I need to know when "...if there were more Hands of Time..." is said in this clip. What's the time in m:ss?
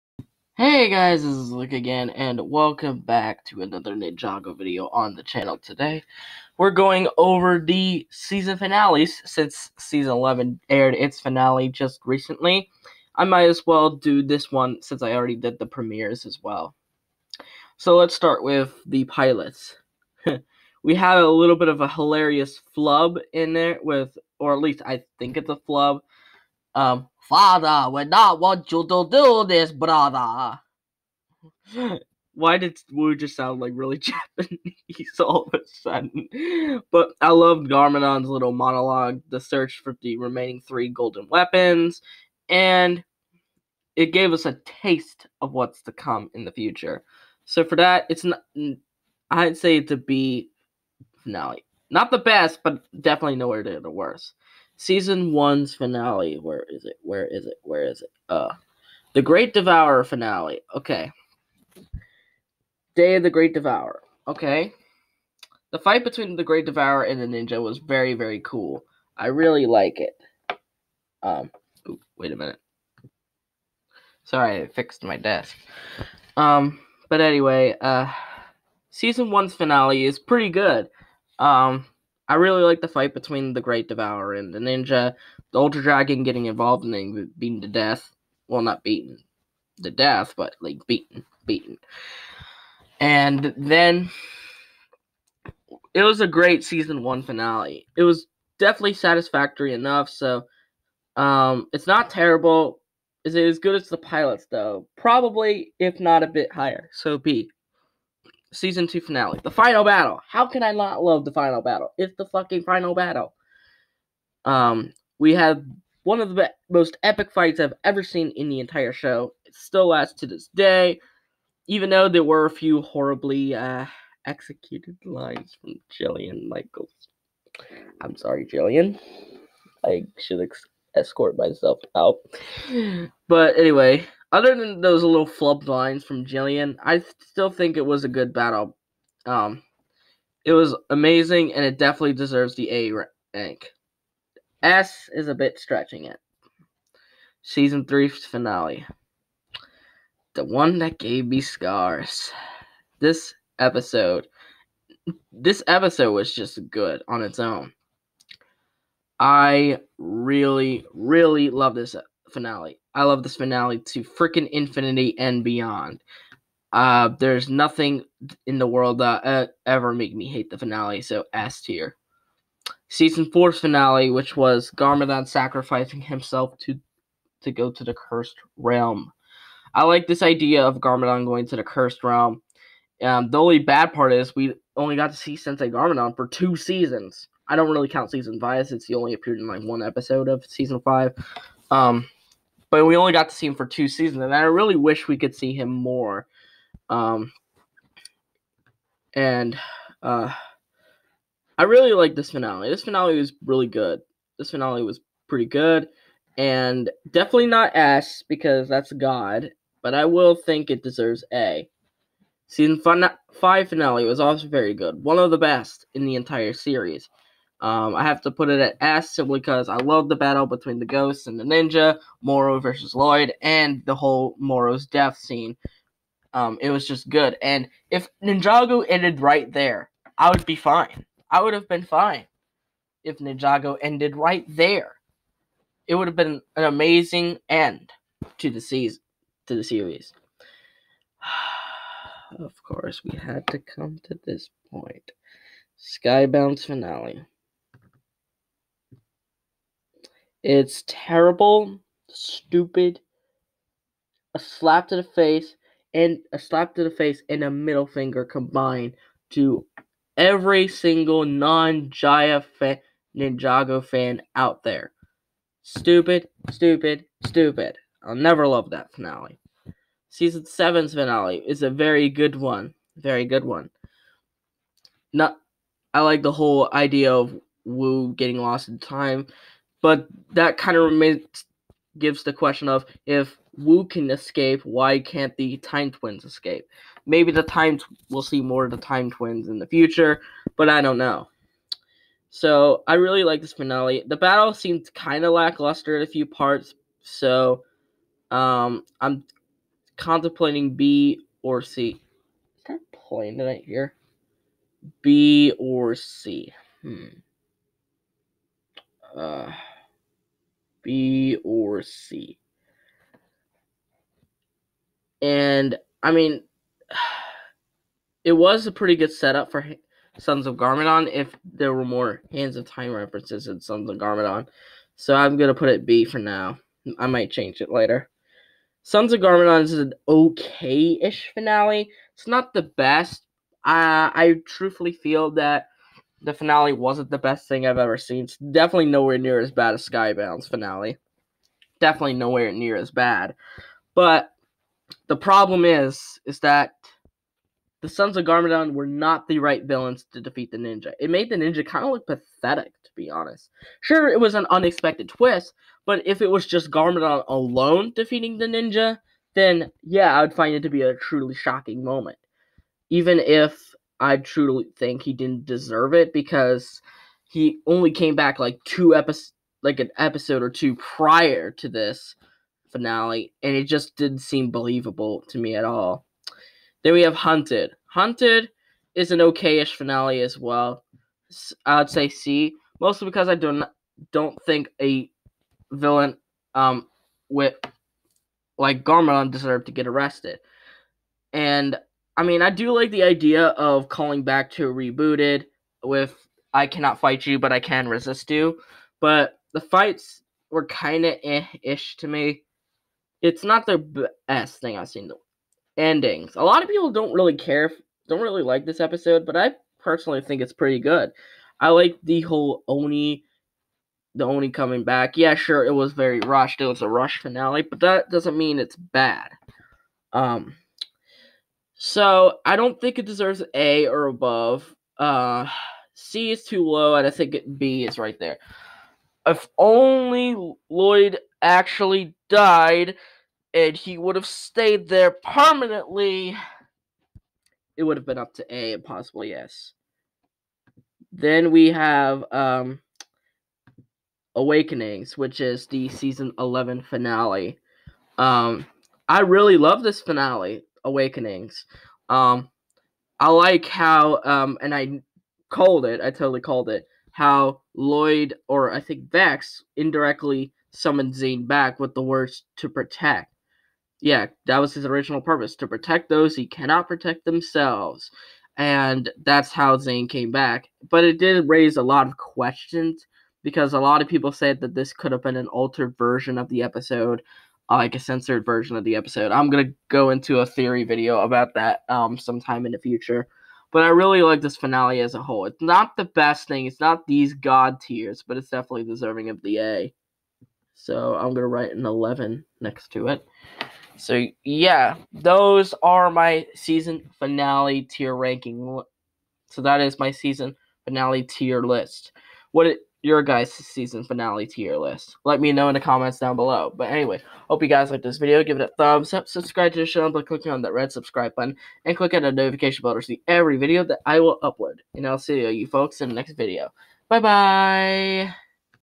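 5:21.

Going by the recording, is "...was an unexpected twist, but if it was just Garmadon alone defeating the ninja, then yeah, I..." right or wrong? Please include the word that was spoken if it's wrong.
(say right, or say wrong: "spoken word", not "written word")
right.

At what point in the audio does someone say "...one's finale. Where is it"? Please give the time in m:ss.
0:55.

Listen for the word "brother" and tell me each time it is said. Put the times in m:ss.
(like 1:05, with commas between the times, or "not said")
0:29.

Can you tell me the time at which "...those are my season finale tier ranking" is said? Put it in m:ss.
8:15.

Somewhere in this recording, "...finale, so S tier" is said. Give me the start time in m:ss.
2:50.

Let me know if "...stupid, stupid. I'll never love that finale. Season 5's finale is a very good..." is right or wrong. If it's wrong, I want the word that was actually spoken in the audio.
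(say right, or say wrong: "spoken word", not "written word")
wrong: "7", not "5".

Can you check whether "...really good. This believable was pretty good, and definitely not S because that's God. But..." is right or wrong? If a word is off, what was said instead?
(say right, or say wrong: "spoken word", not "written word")
wrong: "finale", not "believable".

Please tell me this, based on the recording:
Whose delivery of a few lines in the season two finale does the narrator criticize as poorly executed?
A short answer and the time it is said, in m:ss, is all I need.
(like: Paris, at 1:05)
Jillian Michaels, at 2:05.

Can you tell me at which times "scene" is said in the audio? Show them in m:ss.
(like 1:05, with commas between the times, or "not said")
3:45.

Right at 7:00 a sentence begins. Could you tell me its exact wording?
Um, so I don't think it deserves A or above.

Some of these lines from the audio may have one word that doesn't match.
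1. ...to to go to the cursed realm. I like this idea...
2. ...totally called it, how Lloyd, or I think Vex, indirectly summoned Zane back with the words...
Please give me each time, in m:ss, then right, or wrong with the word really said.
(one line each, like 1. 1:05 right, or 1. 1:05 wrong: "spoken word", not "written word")
1. 2:56 right
2. 7:36 right.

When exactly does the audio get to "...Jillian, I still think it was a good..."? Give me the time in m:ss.
2:16.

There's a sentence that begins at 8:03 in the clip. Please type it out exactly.
But I really like this finale as a whole.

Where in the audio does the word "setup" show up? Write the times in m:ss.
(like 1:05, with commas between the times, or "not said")
5:19.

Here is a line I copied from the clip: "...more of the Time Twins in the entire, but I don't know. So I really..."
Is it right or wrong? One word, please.
wrong.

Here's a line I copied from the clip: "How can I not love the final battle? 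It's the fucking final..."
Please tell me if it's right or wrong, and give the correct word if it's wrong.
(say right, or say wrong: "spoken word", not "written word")
right.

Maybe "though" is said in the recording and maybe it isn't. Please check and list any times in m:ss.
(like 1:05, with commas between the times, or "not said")
1:44, 2:01.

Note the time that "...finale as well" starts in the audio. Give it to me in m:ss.
6:19.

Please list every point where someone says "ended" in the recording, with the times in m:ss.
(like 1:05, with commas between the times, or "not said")
3:48, 3:53.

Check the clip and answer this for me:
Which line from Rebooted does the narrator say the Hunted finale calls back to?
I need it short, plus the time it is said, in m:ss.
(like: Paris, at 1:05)
I cannot fight you, but I can resist you, at 6:36.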